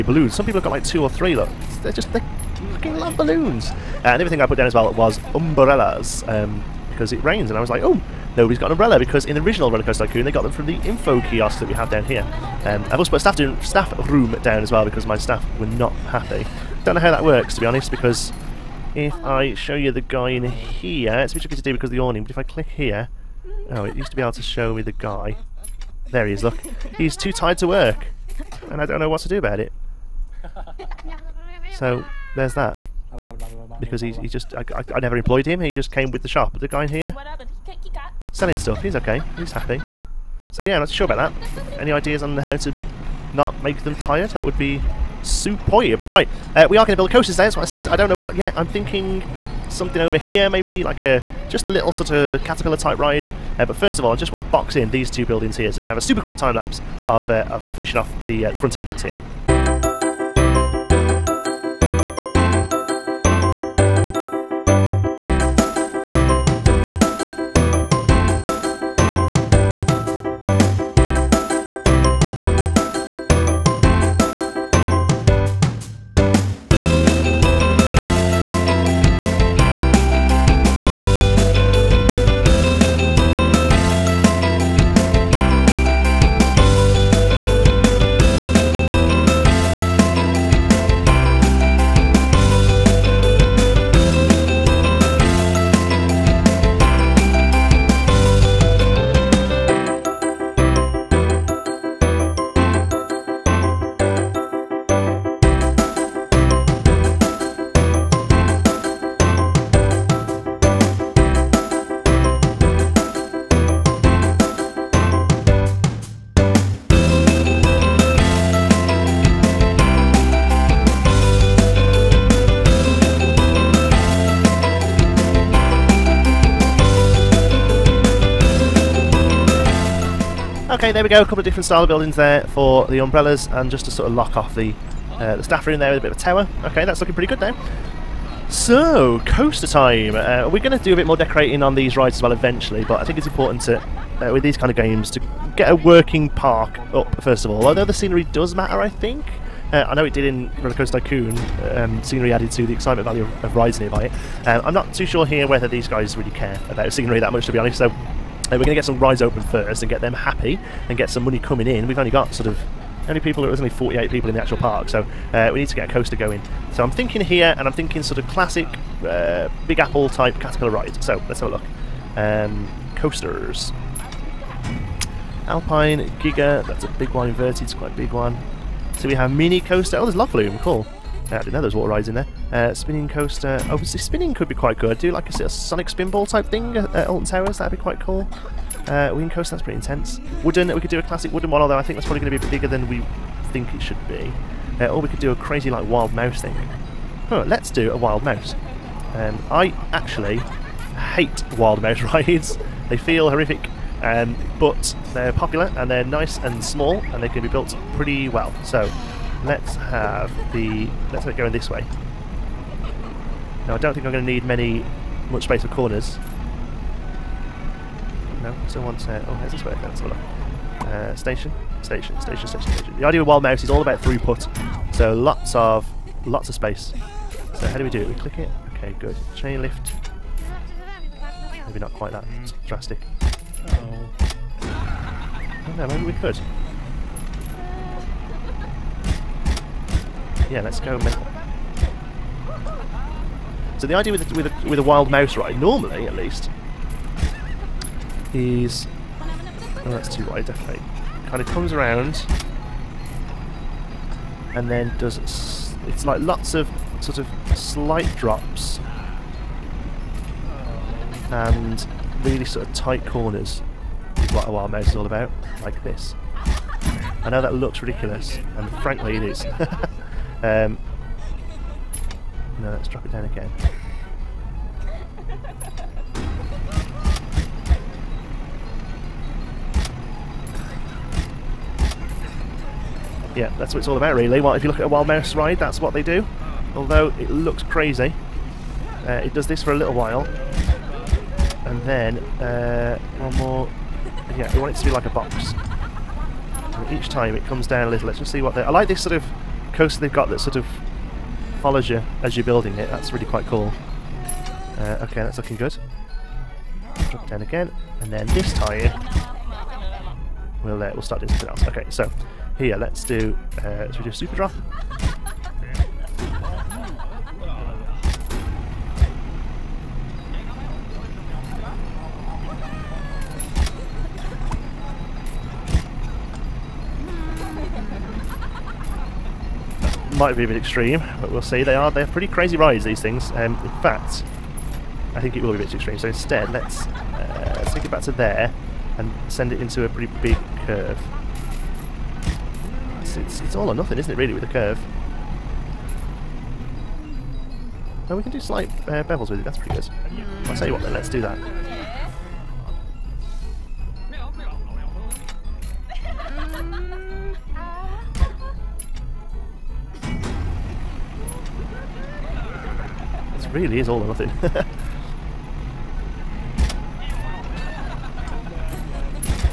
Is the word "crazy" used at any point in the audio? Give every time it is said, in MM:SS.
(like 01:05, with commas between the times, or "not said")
03:15, 04:47, 05:32.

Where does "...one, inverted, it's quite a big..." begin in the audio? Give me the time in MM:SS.
02:57.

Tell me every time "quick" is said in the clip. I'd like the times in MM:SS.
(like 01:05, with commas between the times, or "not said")
00:56.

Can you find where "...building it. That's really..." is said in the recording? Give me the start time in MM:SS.
05:02.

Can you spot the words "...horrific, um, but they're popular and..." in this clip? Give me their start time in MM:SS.
03:23.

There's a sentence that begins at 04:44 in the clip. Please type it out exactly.
Well, if you look at a wild mouse ride, that's what they do.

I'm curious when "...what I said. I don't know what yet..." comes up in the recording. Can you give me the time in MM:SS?
00:47.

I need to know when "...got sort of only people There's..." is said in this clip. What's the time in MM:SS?
02:42.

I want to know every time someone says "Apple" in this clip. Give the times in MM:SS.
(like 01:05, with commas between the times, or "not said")
02:49.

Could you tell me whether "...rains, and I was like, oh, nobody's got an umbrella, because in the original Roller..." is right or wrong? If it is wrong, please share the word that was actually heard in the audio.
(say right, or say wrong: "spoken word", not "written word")
right.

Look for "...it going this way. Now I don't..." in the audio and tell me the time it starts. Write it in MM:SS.
03:31.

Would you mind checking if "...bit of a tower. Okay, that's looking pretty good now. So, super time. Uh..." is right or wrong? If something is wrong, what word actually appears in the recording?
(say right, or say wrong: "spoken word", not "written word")
wrong: "coaster", not "super".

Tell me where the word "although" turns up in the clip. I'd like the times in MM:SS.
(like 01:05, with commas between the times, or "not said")
02:27, 03:11, 04:46.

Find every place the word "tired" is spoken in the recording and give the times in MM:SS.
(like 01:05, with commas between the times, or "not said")
00:27, 00:43.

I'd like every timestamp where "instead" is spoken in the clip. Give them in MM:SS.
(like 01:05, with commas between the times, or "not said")
05:36.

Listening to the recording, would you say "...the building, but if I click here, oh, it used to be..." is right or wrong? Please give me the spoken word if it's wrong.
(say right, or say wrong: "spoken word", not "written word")
wrong: "awning", not "building".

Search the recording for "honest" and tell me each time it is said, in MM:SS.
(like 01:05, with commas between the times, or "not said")
00:17, 02:37.